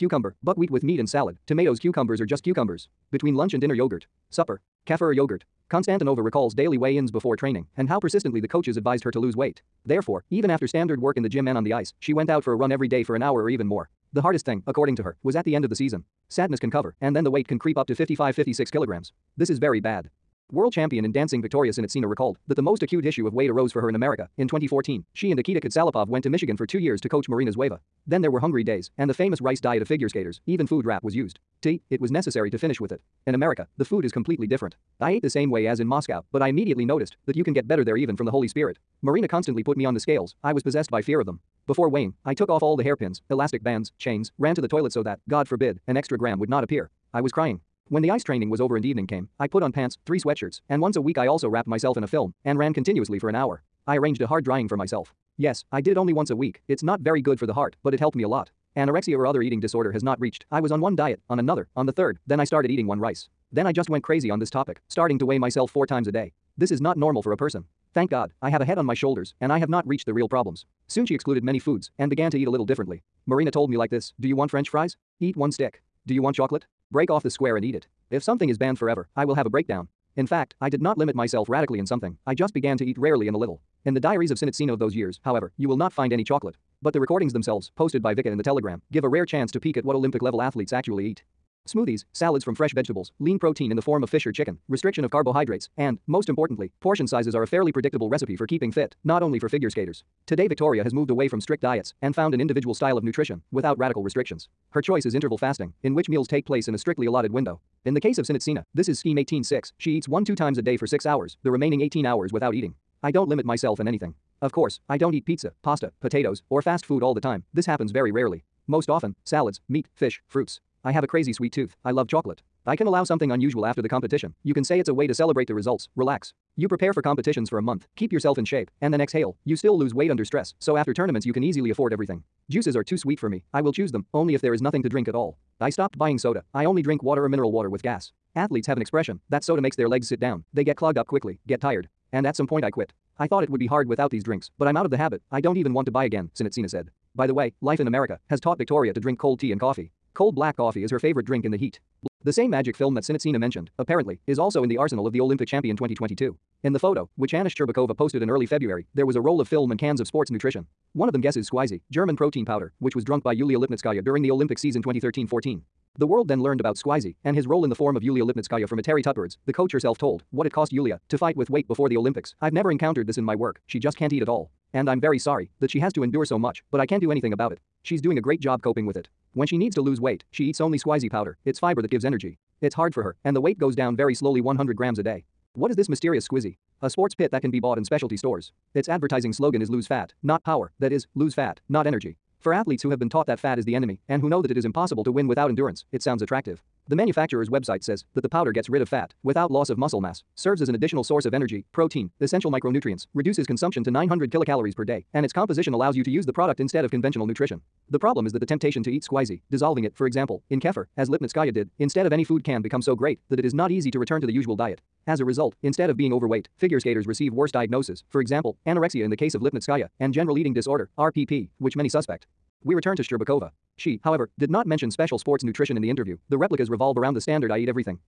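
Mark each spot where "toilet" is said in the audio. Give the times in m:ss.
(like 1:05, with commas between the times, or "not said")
0:44.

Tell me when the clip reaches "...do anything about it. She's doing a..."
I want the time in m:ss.
2:57.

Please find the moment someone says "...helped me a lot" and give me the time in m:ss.
0:57.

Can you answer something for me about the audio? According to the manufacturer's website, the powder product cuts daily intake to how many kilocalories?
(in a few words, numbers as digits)
900 kilocalories.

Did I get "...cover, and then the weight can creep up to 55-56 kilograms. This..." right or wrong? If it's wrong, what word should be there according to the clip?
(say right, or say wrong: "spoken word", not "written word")
right.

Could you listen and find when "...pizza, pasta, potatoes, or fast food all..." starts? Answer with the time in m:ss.
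1:55.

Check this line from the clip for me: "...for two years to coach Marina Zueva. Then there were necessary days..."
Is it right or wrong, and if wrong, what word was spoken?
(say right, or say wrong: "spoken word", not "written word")
wrong: "hungry", not "necessary".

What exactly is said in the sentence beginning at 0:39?
Marina constantly put me on the scales, I was possessed by fear of them.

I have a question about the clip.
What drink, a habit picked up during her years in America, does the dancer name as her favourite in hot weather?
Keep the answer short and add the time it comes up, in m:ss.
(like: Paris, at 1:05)
Cold black coffee, at 2:30.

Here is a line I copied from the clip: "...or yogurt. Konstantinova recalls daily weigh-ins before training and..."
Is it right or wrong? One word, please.
right.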